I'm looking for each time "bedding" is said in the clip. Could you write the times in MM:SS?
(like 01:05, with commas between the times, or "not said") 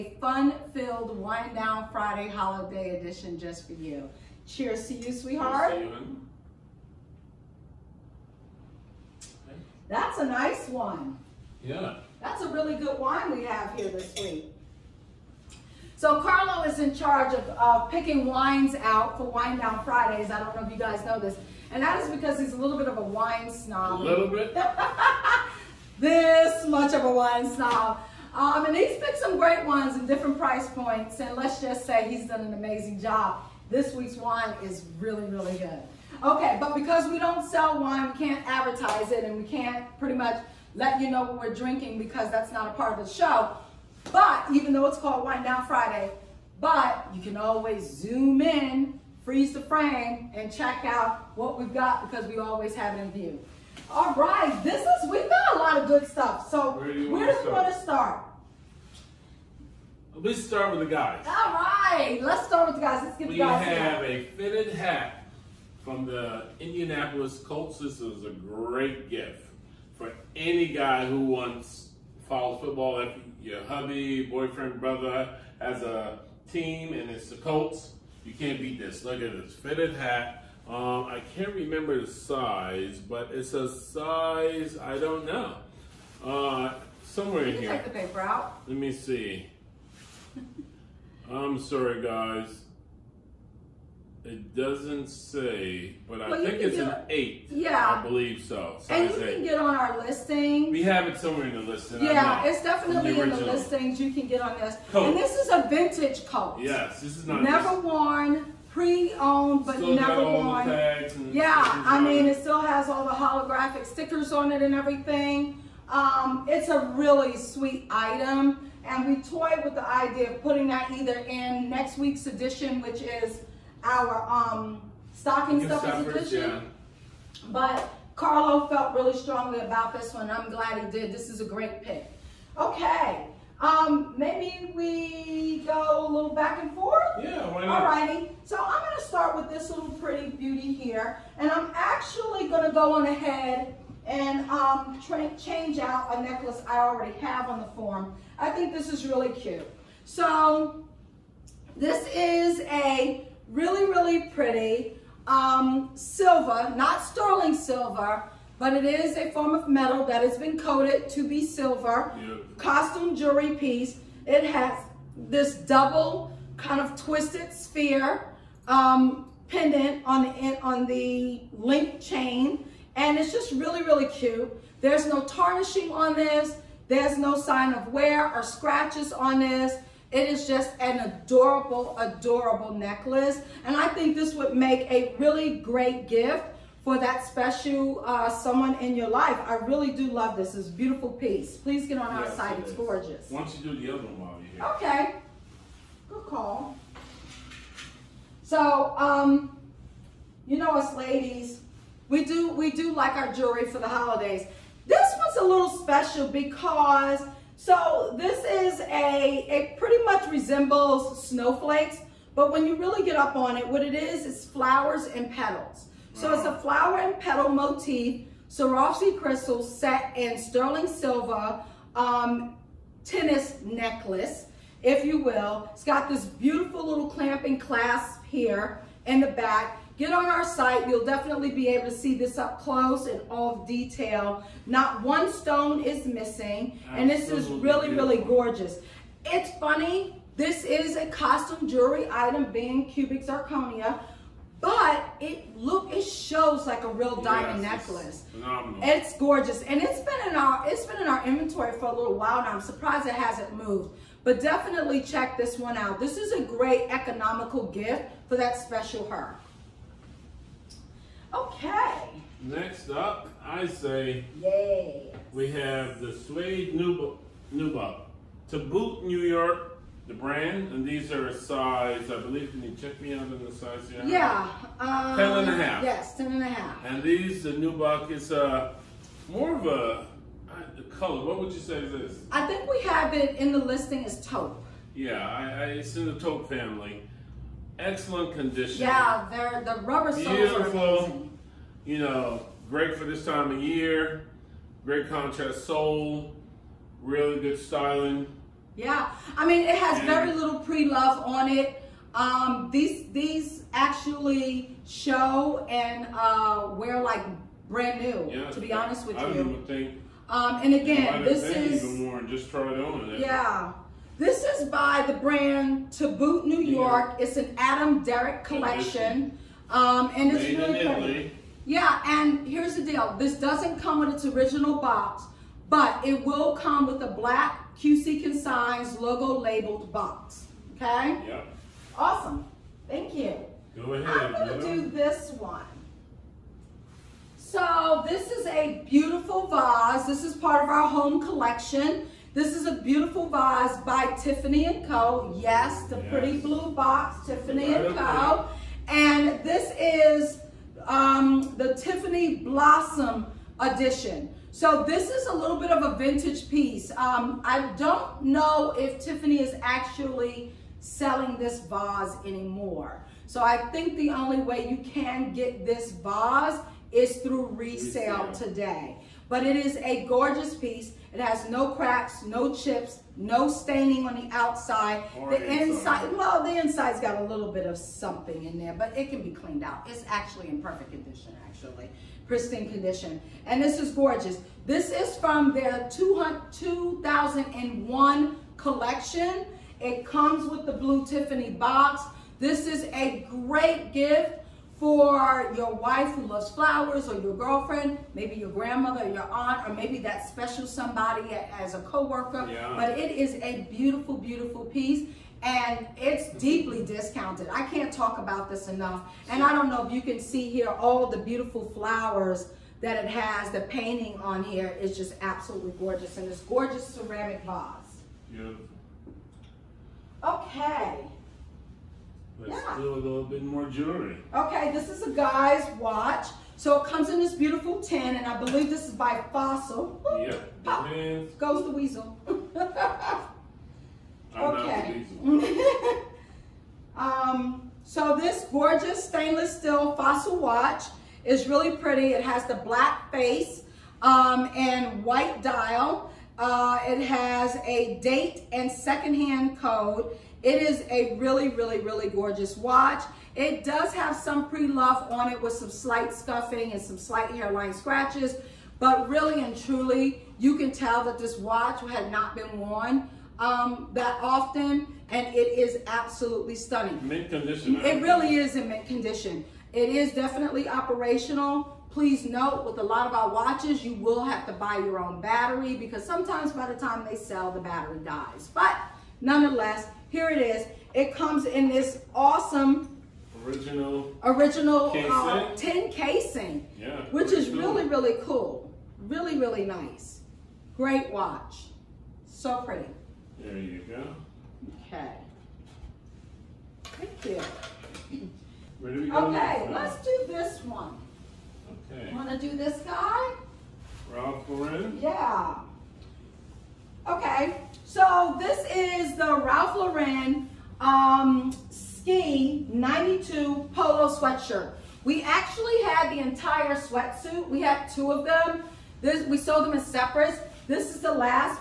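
not said.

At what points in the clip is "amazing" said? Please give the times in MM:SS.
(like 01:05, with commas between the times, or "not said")
00:32, 04:50.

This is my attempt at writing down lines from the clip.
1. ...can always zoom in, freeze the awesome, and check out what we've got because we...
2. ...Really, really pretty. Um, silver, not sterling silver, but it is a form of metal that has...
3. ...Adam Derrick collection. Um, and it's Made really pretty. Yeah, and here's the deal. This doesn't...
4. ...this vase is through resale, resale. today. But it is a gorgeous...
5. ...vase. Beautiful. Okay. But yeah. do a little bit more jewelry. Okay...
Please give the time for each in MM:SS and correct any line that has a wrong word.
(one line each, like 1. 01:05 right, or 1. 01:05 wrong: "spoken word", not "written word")
1. 00:47 wrong: "frame", not "awesome"
2. 02:33 right
3. 05:17 right
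4. 06:05 right
5. 06:57 right.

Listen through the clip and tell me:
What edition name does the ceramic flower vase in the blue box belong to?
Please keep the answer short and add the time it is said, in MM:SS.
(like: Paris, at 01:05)
Tiffany Blossom, at 05:51.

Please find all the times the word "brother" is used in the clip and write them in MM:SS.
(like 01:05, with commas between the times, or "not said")
01:14.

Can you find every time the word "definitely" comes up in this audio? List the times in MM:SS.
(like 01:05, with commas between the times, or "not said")
01:42, 03:51, 04:14, 07:50.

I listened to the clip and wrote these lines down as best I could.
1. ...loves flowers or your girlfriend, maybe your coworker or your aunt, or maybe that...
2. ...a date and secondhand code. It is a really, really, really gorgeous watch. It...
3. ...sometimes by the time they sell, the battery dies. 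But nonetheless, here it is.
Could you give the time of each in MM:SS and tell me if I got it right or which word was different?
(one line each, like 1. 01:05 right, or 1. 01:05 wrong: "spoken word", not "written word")
1. 06:36 wrong: "grandmother", not "coworker"
2. 07:27 right
3. 07:56 right.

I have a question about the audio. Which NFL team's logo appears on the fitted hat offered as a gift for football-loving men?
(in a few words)
Indianapolis Colts.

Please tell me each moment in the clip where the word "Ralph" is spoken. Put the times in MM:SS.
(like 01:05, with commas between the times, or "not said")
08:24, 08:29.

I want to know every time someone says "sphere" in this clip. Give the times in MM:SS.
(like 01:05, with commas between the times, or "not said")
02:47.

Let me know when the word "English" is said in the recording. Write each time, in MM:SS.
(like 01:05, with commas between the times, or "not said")
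not said.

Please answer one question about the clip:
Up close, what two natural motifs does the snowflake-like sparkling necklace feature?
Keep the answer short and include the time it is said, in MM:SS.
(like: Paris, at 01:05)
flowers and petals, at 03:34.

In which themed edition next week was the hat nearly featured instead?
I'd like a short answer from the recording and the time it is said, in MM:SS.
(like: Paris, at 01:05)
stocking substitution, at 02:05.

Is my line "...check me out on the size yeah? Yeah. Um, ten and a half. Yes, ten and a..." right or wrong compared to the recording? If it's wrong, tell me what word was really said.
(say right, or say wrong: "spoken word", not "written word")
right.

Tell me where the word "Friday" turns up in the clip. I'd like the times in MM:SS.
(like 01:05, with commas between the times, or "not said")
00:01, 00:19, 00:45.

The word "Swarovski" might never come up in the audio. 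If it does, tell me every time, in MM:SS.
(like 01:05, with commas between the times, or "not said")
03:38.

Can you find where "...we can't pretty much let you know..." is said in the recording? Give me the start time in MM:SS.
00:39.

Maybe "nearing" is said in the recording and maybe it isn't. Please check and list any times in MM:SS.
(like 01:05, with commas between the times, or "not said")
not said.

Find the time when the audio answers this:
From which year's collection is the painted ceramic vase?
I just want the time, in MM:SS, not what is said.
06:25.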